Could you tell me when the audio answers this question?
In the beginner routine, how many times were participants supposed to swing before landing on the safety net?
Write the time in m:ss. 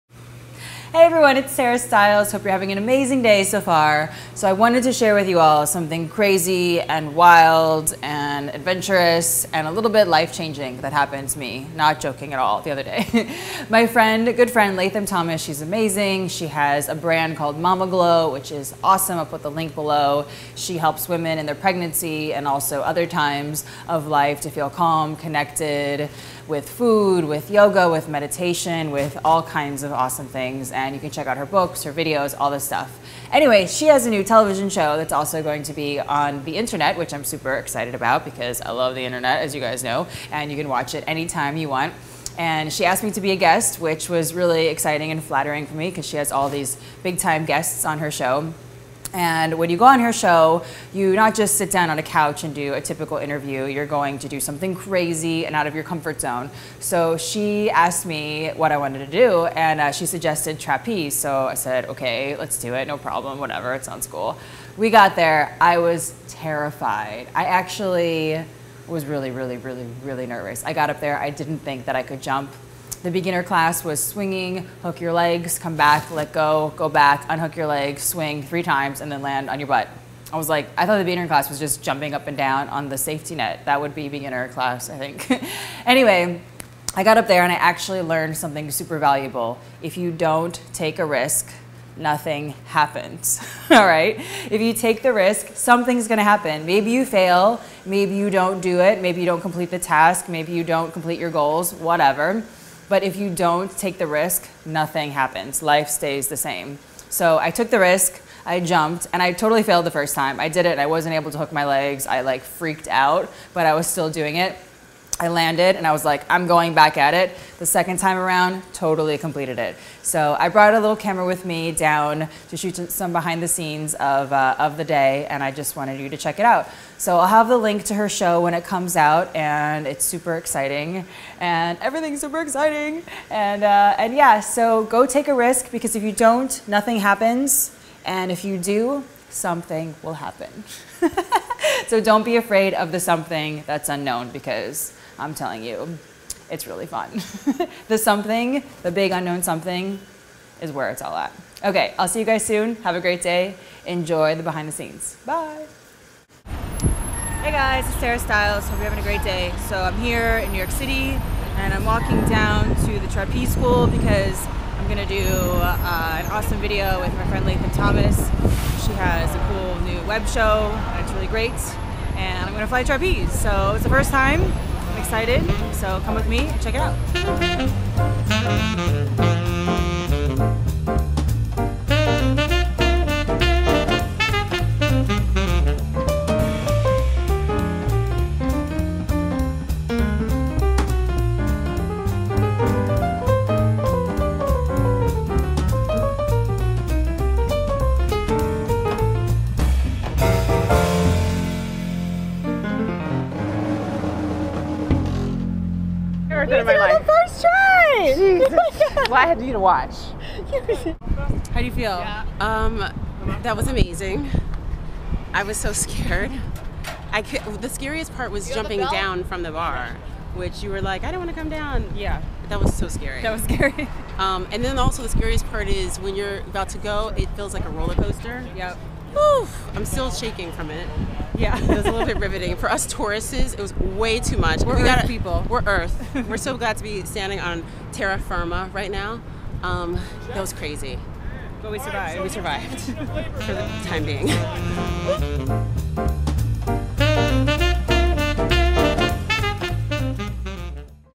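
1:18.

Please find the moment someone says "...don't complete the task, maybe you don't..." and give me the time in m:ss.
1:39.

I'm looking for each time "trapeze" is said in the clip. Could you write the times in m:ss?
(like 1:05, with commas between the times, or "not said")
1:00, 2:43, 2:52.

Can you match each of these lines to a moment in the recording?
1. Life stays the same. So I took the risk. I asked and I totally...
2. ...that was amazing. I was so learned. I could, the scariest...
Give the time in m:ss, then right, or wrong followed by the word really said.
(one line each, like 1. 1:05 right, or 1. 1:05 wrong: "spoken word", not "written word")
1. 1:45 wrong: "jumped", not "asked"
2. 3:33 wrong: "scared", not "learned".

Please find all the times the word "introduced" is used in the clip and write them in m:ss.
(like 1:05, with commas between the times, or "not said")
not said.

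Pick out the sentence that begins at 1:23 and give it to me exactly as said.
That would be beginner class, I think.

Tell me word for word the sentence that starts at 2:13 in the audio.
And, uh, and yeah, so go take a risk because if you don't, nothing happens.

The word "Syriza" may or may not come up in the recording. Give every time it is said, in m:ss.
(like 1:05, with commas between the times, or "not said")
not said.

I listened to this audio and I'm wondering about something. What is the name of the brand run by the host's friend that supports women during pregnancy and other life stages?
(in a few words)
Mama Glow.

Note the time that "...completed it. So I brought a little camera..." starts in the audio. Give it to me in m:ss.
1:59.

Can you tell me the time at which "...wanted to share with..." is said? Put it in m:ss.
0:04.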